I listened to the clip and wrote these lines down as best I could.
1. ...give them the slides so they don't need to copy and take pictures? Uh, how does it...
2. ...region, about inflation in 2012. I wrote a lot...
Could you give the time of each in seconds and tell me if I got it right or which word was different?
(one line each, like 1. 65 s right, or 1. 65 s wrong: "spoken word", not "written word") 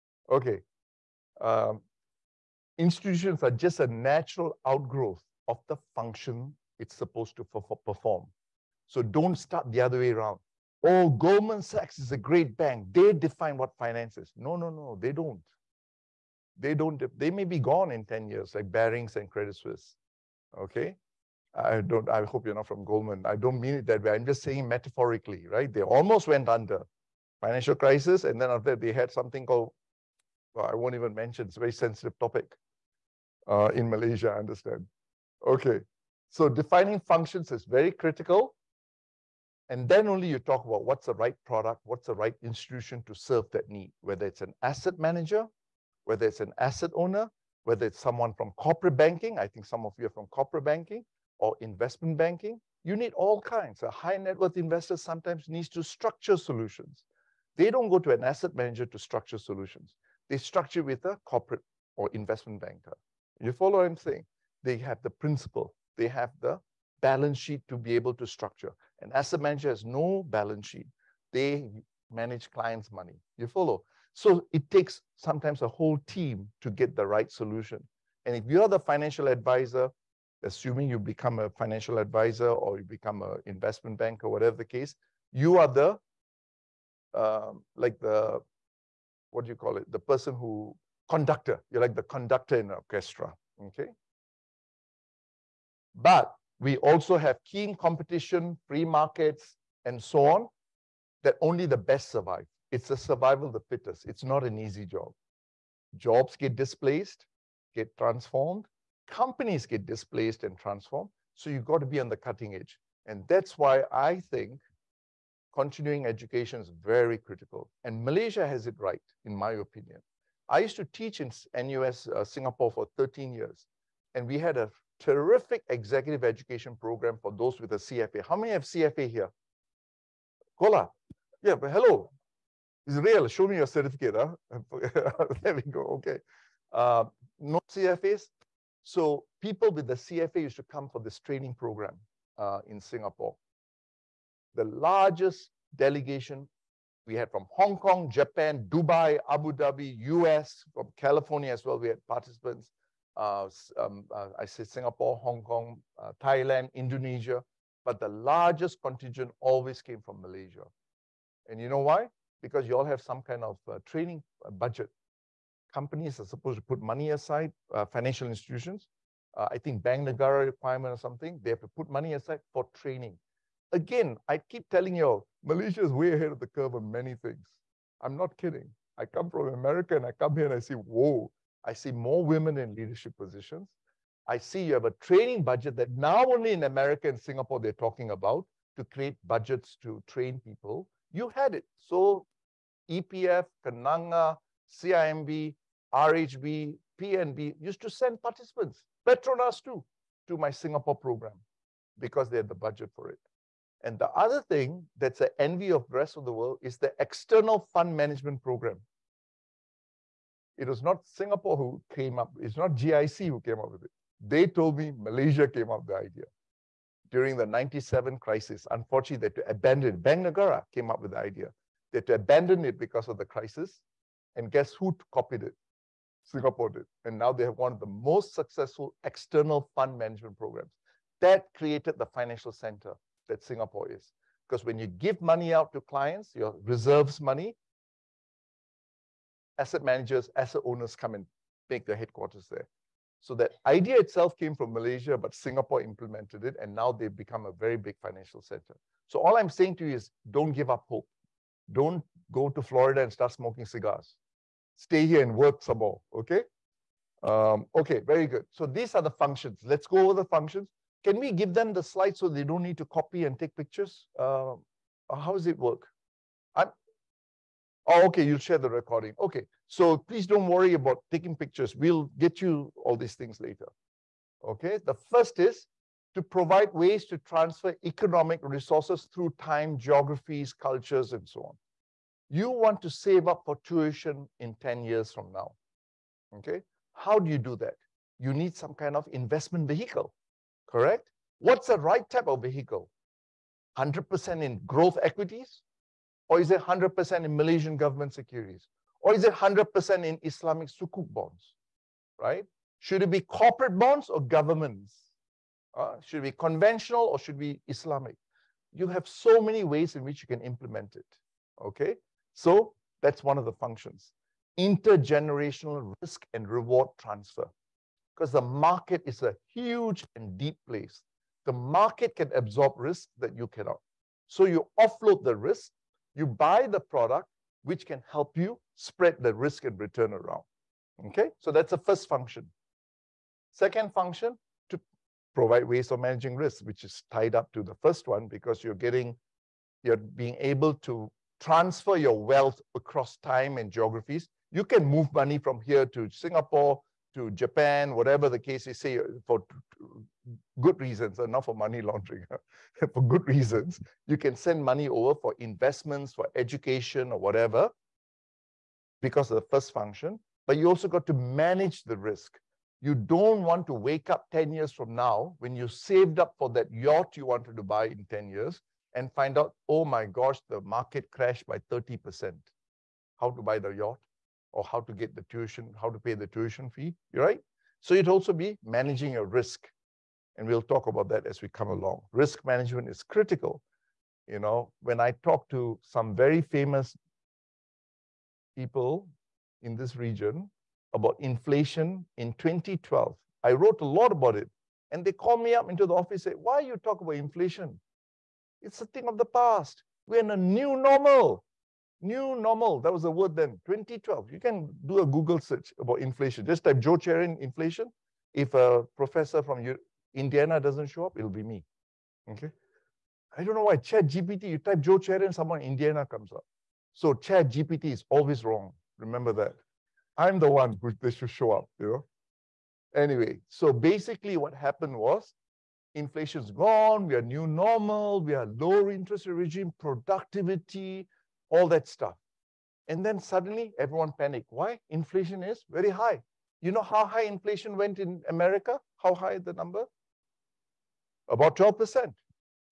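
1. 261 s right
2. 389 s right.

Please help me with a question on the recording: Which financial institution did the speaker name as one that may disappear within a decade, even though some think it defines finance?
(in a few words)
Goldman Sachs.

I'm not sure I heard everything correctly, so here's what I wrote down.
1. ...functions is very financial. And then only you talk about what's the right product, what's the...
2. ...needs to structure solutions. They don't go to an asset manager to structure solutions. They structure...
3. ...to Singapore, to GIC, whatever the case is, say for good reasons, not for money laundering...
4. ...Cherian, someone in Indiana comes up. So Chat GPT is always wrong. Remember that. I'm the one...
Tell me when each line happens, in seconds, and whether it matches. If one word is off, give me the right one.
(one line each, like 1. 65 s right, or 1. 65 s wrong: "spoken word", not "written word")
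1. 37 s wrong: "critical", not "financial"
2. 55 s right
3. 345 s wrong: "Japan", not "GIC"
4. 414 s right.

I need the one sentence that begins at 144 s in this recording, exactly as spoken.
The largest delegation we had from Hong Kong, Japan, Dubai, Abu Dhabi, US, from California as well.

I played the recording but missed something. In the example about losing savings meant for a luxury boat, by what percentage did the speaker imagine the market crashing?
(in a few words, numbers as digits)
30%.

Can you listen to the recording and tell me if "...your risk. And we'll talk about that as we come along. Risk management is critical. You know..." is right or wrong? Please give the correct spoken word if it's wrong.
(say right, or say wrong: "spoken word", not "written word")
right.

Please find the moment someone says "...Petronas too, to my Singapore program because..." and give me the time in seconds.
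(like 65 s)
199 s.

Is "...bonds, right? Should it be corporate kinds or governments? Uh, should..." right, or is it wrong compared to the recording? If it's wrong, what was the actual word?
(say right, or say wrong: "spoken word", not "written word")
wrong: "bonds", not "kinds".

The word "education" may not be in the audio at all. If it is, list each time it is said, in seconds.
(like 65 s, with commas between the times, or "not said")
116 s, 126 s, 356 s.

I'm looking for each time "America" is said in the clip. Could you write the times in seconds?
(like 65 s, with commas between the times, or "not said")
179 s, 186 s, 438 s.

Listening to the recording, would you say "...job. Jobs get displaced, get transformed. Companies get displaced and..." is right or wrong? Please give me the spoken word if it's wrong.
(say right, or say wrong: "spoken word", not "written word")
right.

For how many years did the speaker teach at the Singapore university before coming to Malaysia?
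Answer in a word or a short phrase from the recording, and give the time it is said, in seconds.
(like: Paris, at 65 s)
13, at 122 s.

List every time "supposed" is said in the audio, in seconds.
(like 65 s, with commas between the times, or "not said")
6 s, 166 s.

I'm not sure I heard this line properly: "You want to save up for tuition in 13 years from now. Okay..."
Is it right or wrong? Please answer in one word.
wrong.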